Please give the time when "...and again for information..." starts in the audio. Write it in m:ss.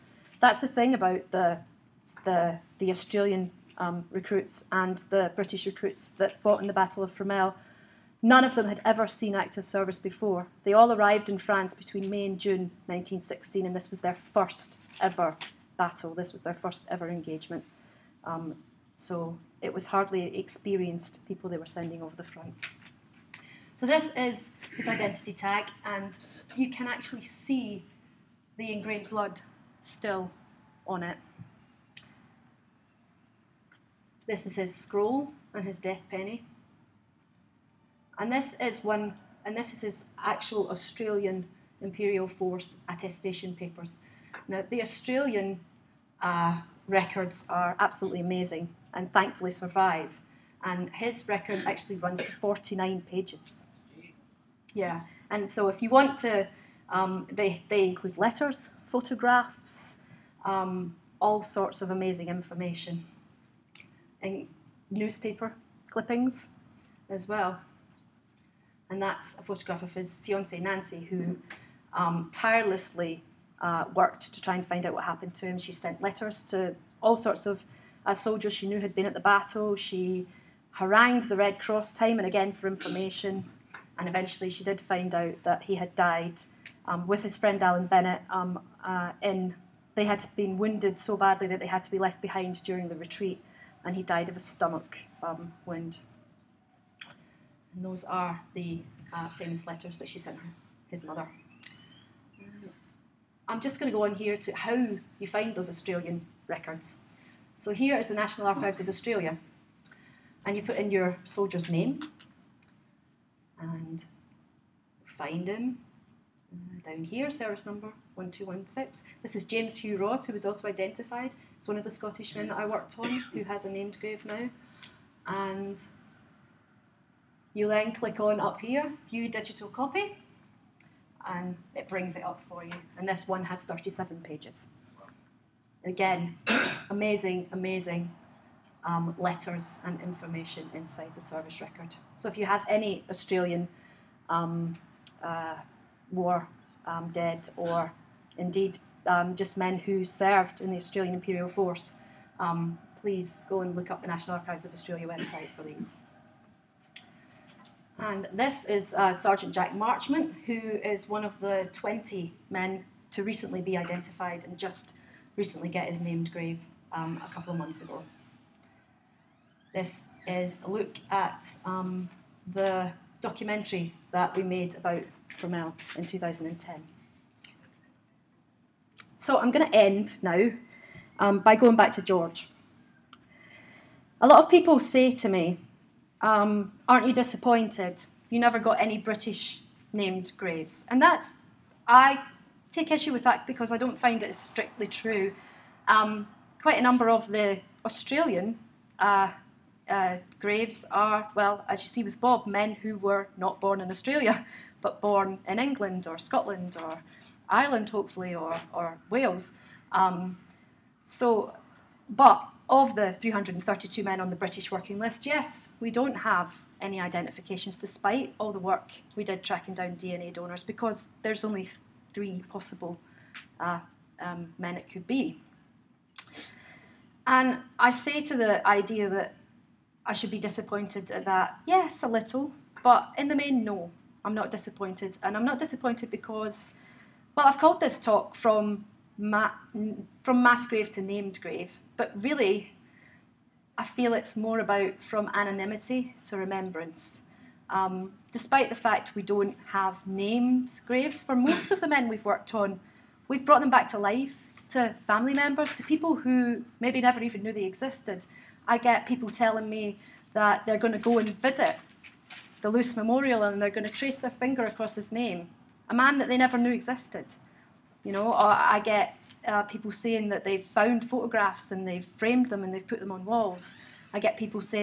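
1:22.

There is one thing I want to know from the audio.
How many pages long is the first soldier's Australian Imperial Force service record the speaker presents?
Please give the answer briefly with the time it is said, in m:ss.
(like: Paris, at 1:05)
49, at 0:52.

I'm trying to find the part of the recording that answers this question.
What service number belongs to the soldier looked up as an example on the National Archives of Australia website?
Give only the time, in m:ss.
1:58.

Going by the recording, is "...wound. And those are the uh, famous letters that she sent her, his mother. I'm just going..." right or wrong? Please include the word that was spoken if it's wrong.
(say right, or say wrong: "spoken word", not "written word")
right.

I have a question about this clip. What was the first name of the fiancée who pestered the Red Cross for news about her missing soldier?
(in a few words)
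Nancy.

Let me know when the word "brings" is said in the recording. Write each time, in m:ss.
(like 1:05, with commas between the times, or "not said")
2:11.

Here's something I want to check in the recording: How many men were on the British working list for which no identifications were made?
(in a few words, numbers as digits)
332.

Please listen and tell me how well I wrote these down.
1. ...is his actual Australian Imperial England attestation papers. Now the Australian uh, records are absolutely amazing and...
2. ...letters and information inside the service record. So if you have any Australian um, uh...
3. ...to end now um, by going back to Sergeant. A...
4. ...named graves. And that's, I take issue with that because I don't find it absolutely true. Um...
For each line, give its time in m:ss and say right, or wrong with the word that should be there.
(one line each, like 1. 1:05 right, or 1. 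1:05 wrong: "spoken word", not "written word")
1. 0:39 wrong: "Force", not "England"
2. 2:19 right
3. 2:59 wrong: "George", not "Sergeant"
4. 3:09 wrong: "strictly", not "absolutely".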